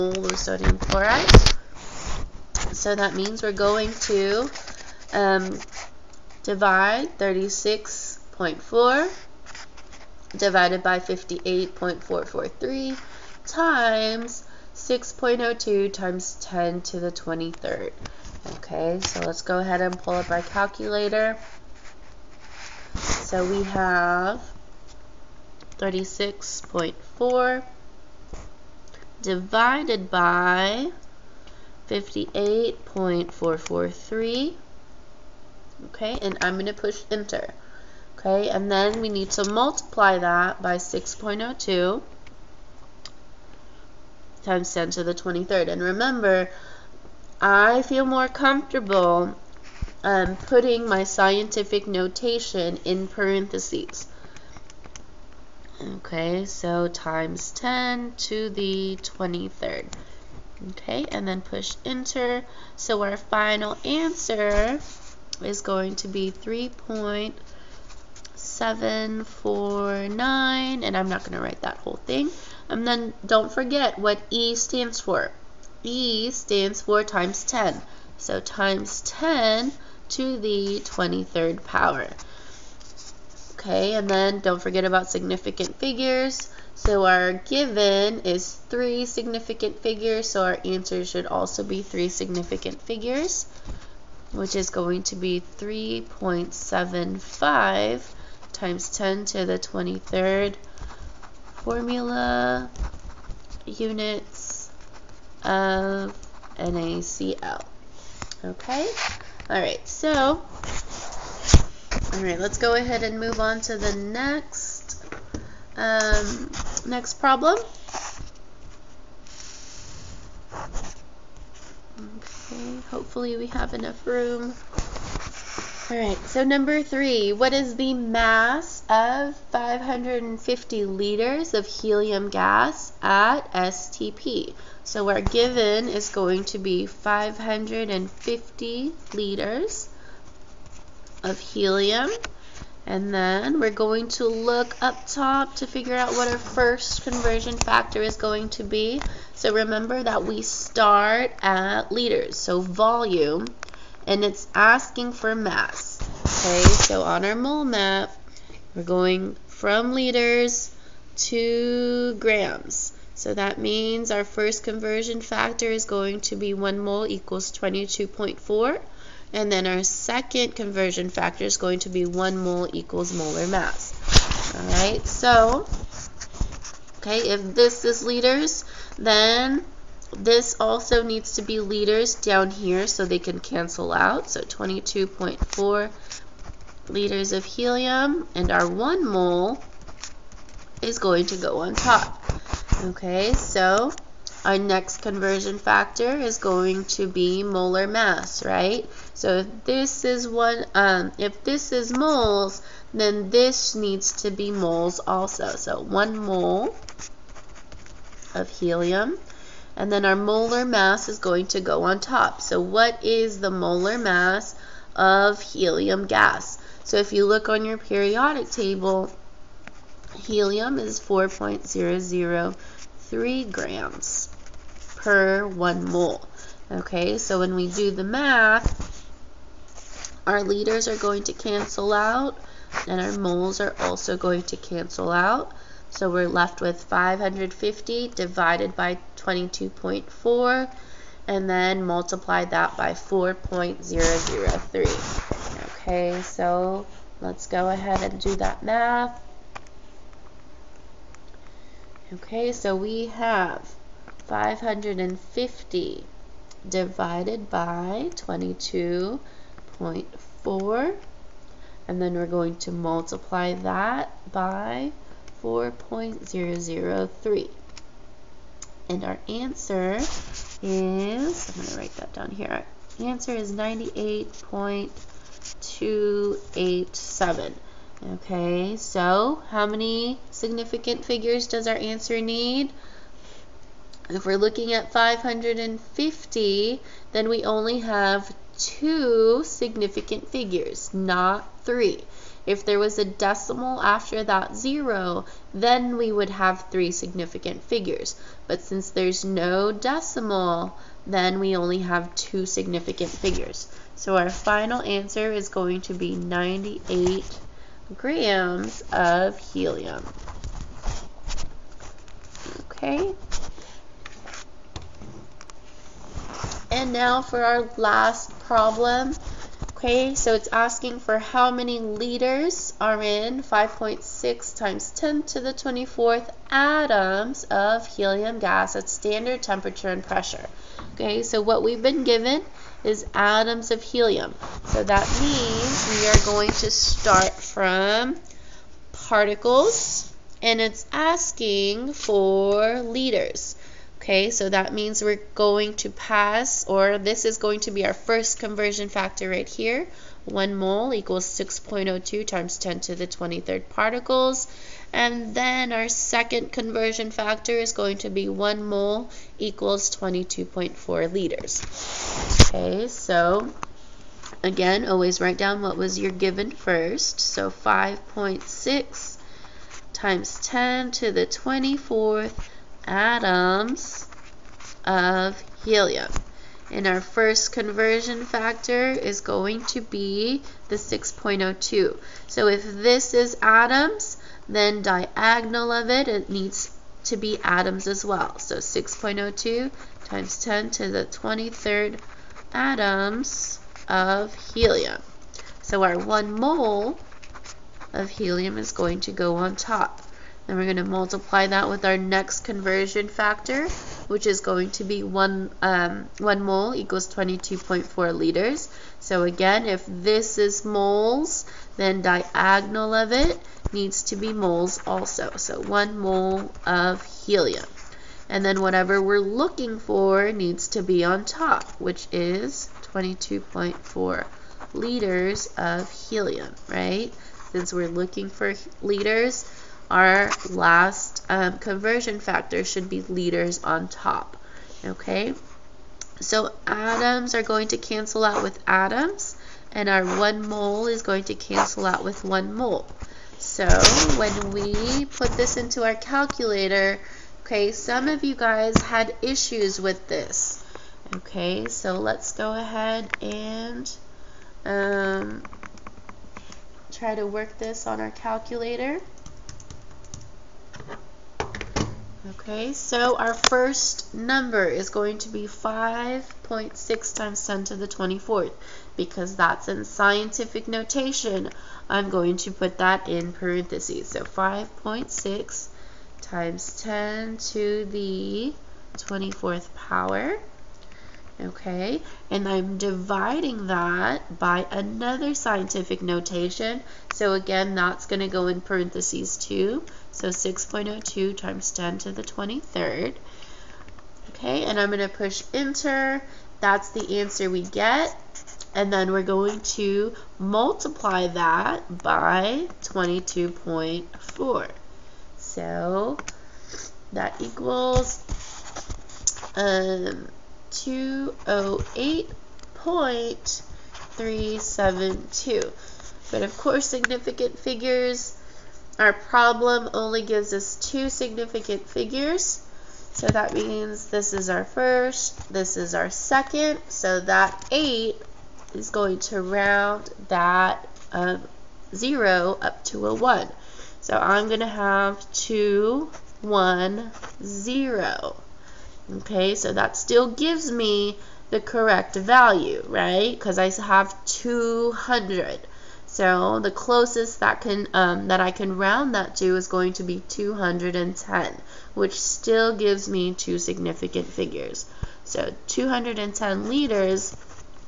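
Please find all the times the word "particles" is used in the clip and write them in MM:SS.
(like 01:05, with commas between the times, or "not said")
05:38, 05:53.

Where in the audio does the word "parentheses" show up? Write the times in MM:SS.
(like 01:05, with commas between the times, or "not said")
00:53, 07:53, 08:08.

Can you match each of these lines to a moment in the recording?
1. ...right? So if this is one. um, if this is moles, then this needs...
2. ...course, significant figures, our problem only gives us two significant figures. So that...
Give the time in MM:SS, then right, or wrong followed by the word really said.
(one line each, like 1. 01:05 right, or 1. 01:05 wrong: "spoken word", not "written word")
1. 03:18 right
2. 08:36 right.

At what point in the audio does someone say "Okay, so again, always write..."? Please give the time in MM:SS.
06:02.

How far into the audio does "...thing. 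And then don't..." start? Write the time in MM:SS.
01:12.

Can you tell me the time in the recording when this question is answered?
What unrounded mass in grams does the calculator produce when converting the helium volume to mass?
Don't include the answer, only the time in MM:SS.
04:33.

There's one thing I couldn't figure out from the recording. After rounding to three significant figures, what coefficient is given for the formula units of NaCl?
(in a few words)
3.75.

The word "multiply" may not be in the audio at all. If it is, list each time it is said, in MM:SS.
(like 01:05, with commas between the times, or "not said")
00:39, 04:01, 04:22, 06:40, 08:20.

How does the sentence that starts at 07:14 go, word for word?
Okay, so atoms are going to cancel out with atoms, and our one mole is going to cancel out with one mole.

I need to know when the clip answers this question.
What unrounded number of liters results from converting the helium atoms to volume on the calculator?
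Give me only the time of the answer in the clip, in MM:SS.
08:30.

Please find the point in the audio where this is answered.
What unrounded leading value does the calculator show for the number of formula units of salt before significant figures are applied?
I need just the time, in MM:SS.
01:06.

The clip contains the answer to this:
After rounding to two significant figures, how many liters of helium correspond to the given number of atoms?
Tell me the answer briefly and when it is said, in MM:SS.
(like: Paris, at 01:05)
210 liters, at 09:15.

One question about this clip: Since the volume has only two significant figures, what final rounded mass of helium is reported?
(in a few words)
98 grams.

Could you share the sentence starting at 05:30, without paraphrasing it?
Okay, so what we've been given is atoms of helium.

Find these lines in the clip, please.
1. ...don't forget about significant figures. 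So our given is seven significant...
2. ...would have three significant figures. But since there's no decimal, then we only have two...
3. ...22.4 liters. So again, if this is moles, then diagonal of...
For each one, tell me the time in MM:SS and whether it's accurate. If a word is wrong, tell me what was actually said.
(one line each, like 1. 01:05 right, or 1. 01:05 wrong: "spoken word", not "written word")
1. 01:24 wrong: "three", not "seven"
2. 04:56 right
3. 06:47 right.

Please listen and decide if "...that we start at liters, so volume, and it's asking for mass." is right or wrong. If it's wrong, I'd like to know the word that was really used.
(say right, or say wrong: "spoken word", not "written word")
right.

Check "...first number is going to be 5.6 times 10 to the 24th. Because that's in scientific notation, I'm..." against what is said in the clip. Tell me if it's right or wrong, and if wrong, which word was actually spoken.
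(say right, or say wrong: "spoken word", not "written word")
right.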